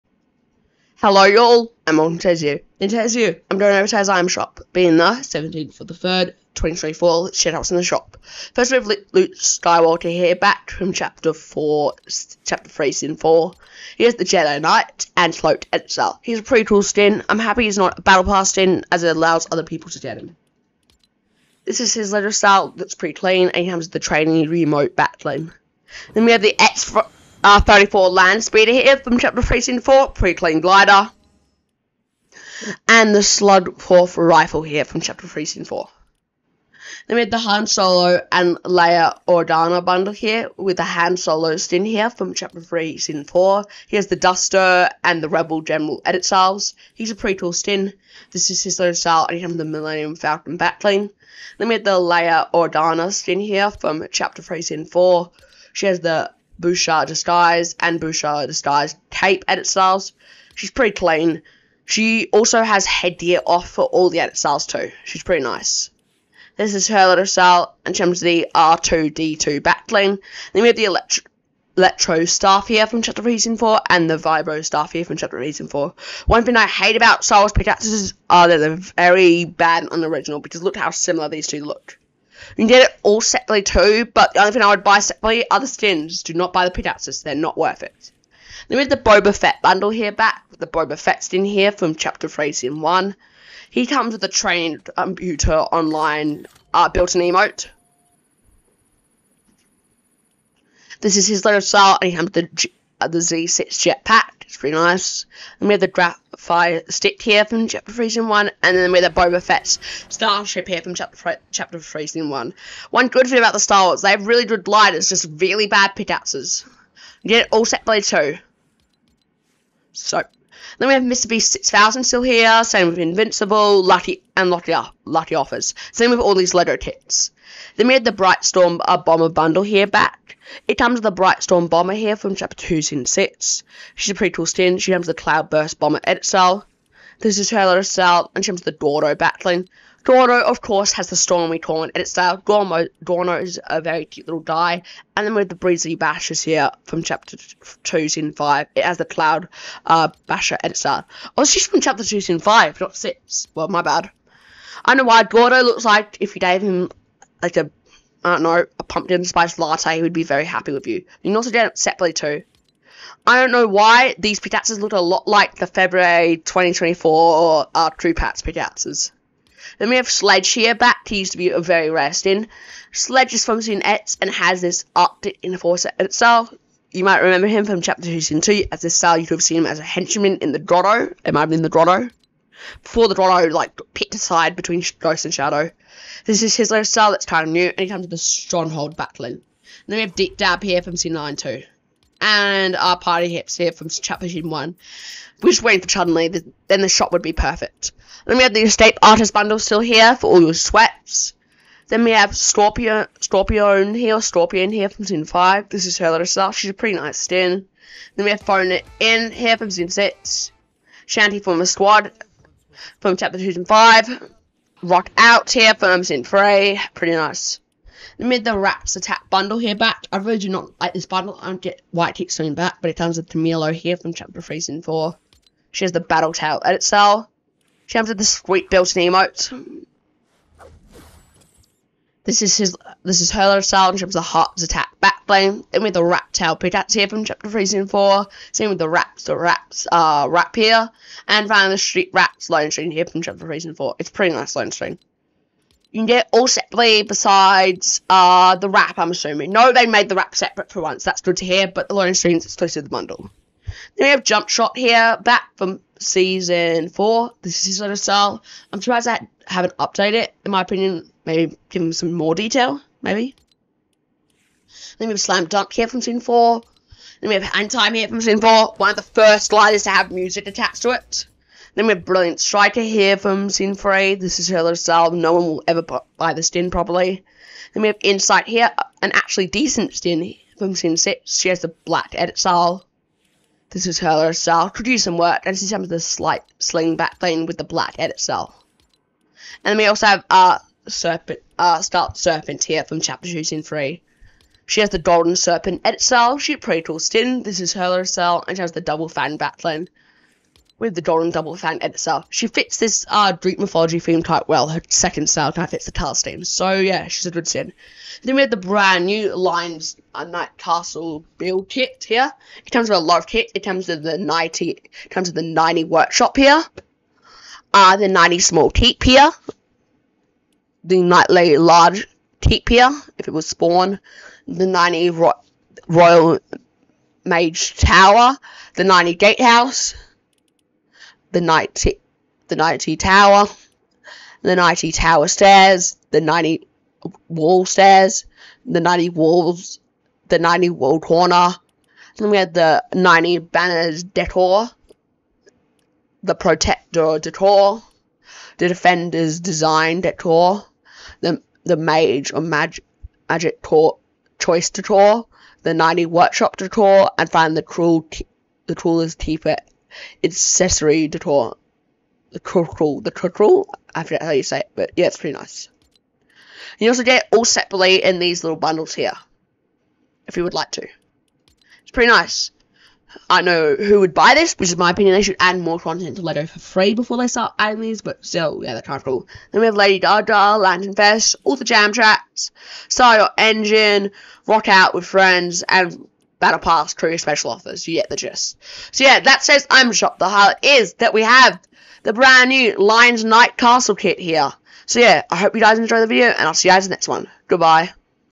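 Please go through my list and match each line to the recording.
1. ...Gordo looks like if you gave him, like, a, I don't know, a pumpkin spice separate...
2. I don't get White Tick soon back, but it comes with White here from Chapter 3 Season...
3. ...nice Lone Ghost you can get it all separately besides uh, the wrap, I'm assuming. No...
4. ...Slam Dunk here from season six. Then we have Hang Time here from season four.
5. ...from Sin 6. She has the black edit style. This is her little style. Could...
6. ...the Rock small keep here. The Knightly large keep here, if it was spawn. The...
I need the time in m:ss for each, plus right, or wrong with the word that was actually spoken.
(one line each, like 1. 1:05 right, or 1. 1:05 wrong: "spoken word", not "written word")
1. 2:35 wrong: "latte", not "separate"
2. 3:41 wrong: "Tamilo", not "White"
3. 4:04 wrong: "String", not "Ghost"
4. 4:25 wrong: "four", not "six"
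5. 4:40 right
6. 5:17 wrong: "Knightly", not "Rock".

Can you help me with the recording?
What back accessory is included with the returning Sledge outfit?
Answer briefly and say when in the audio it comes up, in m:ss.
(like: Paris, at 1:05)
Stronghold, at 3:08.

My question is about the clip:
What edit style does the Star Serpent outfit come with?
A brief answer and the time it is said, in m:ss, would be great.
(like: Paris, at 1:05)
Golden Serpent, at 4:54.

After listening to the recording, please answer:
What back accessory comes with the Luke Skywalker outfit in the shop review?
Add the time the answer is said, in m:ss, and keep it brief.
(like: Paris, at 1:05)
Training remote, at 0:23.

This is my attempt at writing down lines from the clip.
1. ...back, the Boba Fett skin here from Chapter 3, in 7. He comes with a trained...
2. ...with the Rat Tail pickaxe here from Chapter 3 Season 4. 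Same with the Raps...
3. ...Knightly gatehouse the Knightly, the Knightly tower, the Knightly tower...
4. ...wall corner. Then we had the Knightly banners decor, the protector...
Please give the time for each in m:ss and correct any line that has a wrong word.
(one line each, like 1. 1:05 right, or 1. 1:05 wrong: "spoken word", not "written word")
1. 1:30 wrong: "1", not "7"
2. 3:55 right
3. 5:28 right
4. 5:40 right.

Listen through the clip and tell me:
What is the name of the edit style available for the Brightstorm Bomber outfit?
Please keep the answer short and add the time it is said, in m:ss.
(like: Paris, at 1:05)
Cloudburst Bomber, at 2:15.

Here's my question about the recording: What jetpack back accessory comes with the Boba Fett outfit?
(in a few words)
Z6 jetpack.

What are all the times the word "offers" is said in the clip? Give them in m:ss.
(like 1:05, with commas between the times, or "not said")
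2:05, 6:27.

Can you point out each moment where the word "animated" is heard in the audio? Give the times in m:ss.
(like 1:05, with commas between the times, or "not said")
not said.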